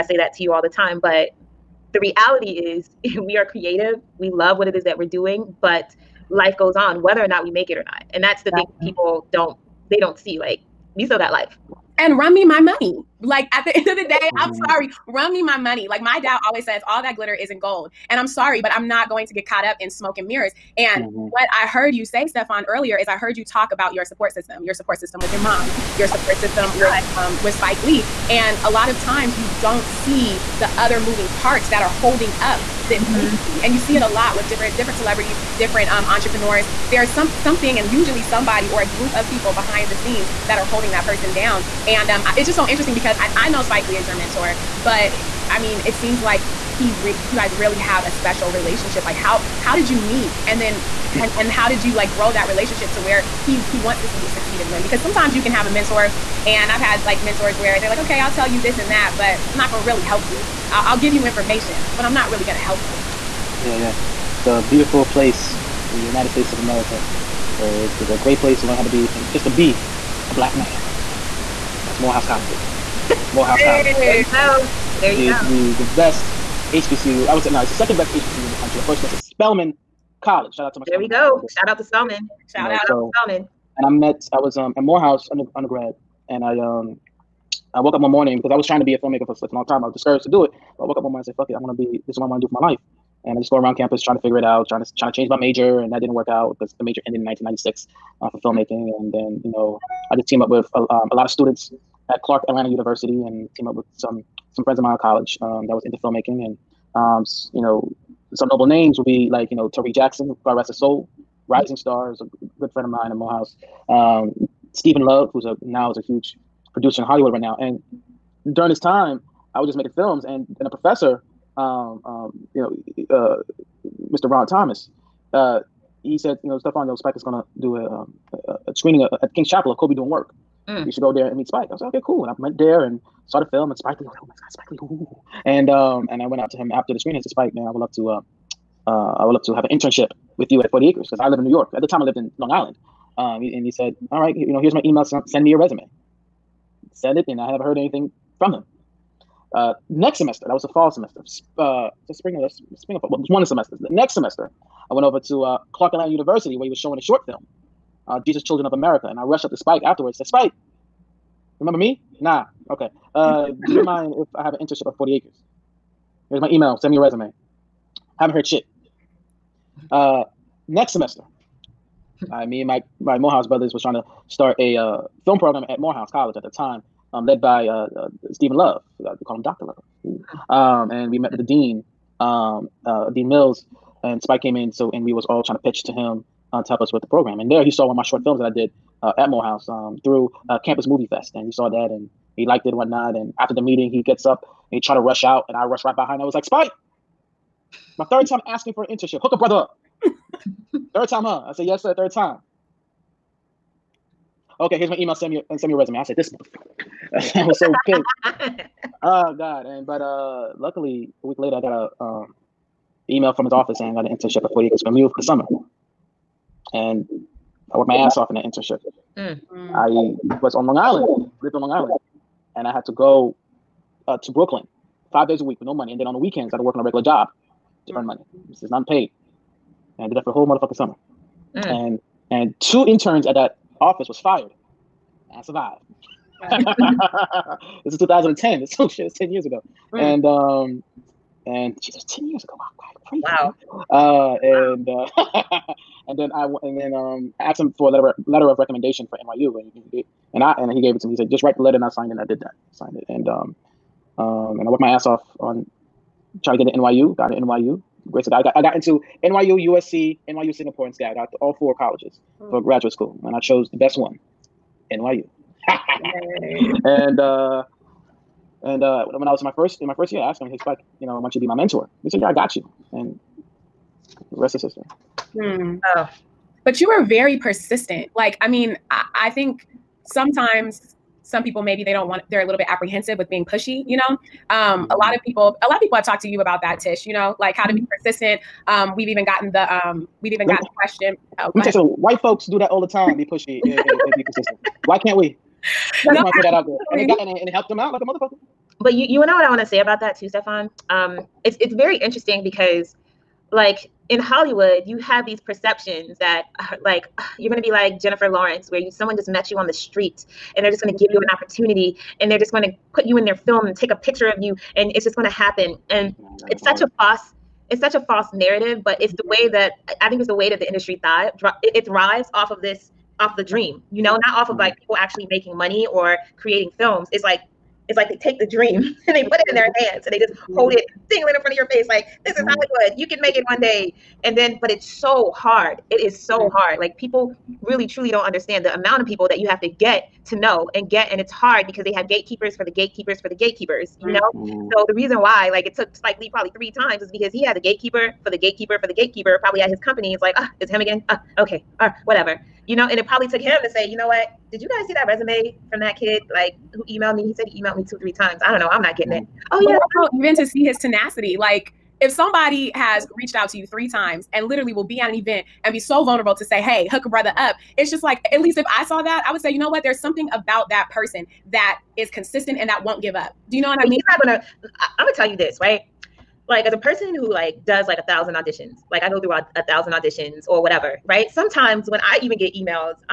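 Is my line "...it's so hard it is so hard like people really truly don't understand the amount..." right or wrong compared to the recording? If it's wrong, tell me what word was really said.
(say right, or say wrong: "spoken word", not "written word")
right.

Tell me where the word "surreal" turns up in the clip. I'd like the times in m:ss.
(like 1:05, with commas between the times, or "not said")
not said.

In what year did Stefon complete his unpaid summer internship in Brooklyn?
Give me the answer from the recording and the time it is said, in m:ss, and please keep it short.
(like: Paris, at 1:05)
2010, at 3:57.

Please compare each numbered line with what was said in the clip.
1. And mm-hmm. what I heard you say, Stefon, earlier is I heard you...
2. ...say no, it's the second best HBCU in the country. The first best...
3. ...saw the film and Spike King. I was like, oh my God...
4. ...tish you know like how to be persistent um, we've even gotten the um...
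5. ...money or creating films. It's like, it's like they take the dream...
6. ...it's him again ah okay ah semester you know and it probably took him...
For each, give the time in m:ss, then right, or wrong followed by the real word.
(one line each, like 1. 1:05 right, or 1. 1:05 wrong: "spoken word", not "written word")
1. 0:20 right
2. 1:17 right
3. 2:13 wrong: "Lee", not "King"
4. 4:46 right
5. 5:25 right
6. 5:50 wrong: "whatever", not "semester".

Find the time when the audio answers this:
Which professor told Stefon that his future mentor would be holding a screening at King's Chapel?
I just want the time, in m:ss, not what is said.
2:04.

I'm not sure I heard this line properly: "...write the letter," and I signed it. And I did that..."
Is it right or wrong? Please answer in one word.
right.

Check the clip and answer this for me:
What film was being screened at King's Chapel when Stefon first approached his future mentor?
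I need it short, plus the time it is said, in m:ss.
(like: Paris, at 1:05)
Kobe Doin' Work, at 2:09.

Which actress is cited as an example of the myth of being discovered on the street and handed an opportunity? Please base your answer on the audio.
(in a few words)
Jennifer Lawrence.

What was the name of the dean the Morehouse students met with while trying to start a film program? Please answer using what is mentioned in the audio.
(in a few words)
Dean Mills.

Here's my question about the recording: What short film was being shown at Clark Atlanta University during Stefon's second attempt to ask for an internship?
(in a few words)
Jesus Children of America.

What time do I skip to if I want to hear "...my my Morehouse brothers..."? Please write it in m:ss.
2:52.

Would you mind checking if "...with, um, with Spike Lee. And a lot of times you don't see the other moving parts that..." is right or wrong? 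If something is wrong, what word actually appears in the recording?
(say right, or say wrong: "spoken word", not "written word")
right.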